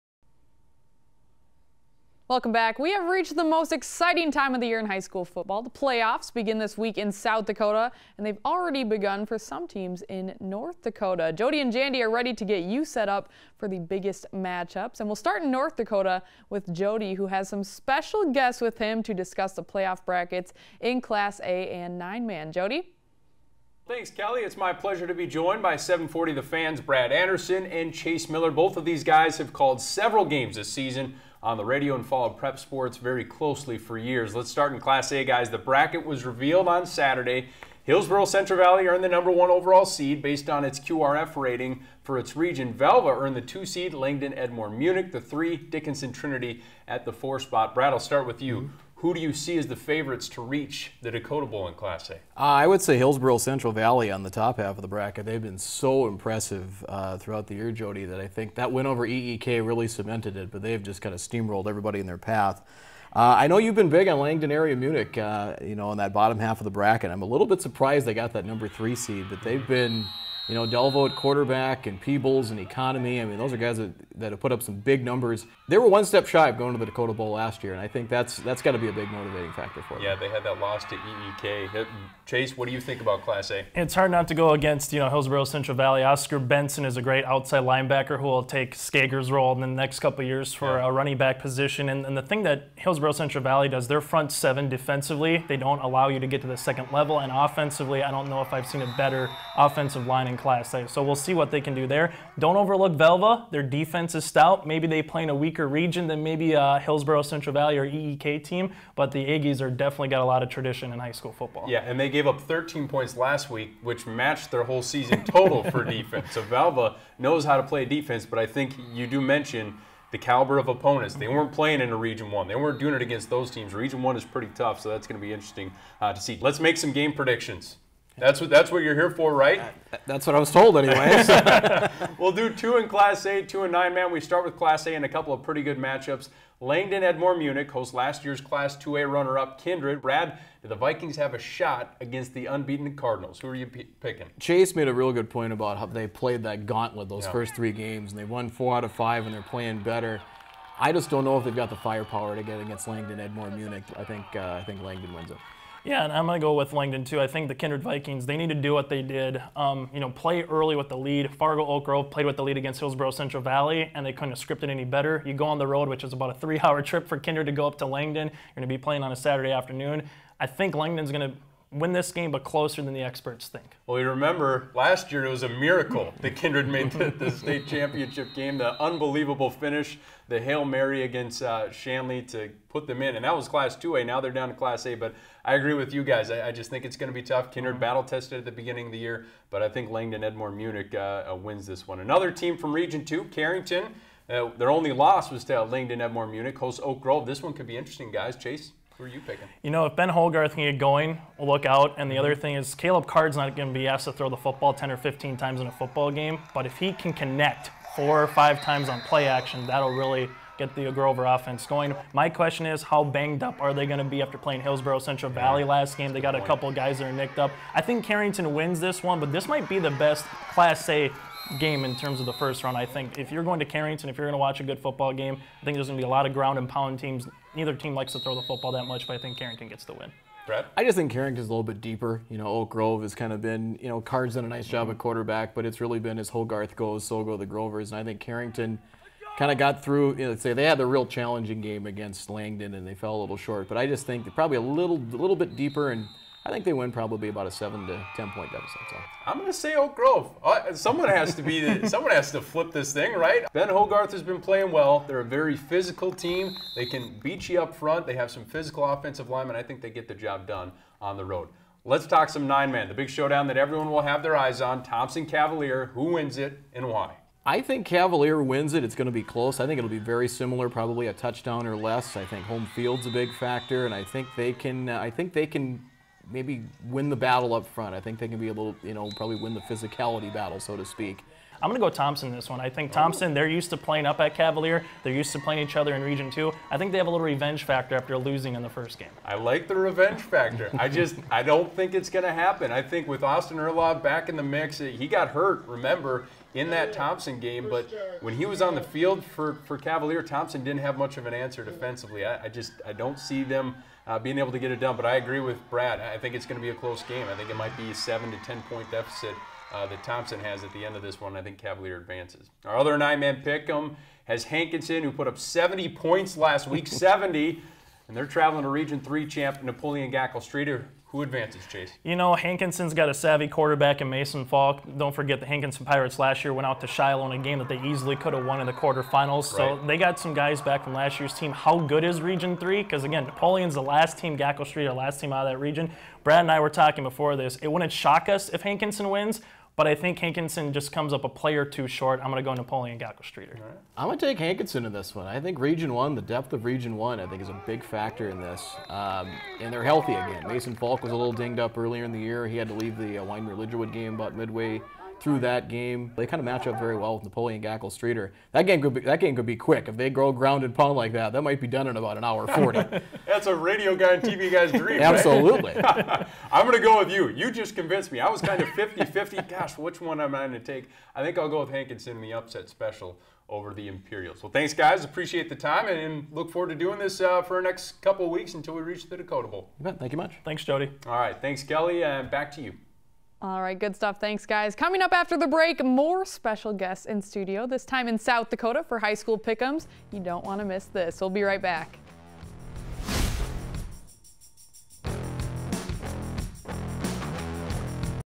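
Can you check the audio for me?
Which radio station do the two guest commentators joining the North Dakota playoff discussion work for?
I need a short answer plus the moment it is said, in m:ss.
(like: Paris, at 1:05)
740 The Fans, at 0:25.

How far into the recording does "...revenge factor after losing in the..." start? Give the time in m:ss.
4:47.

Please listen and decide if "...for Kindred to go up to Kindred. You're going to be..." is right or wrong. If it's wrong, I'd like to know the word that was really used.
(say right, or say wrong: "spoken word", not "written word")
wrong: "Langdon", not "Kindred".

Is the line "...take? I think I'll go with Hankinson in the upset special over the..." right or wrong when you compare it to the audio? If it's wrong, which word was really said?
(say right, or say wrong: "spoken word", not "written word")
right.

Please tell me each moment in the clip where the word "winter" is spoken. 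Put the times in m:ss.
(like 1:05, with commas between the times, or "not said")
not said.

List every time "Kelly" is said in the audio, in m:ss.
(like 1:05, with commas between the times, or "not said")
0:24, 6:21.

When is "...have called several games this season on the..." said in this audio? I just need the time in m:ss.
0:29.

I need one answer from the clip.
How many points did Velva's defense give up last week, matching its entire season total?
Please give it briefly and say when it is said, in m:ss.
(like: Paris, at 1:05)
13, at 1:52.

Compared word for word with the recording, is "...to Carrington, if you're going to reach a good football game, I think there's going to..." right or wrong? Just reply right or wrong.
wrong.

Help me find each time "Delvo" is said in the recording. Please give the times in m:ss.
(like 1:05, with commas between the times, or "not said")
1:10.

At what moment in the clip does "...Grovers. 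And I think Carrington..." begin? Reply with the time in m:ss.
3:57.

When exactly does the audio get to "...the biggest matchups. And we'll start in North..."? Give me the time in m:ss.
0:13.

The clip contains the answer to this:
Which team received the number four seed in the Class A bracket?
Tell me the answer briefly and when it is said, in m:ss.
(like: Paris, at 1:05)
Dickinson Trinity, at 0:45.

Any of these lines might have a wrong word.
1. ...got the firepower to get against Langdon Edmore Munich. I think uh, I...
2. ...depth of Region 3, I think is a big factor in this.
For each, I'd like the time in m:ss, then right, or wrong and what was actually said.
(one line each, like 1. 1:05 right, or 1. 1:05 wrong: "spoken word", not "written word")
1. 2:31 right
2. 5:46 wrong: "1", not "3".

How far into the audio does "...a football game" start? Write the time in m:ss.
3:25.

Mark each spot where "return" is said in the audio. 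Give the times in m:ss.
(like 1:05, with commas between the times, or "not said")
not said.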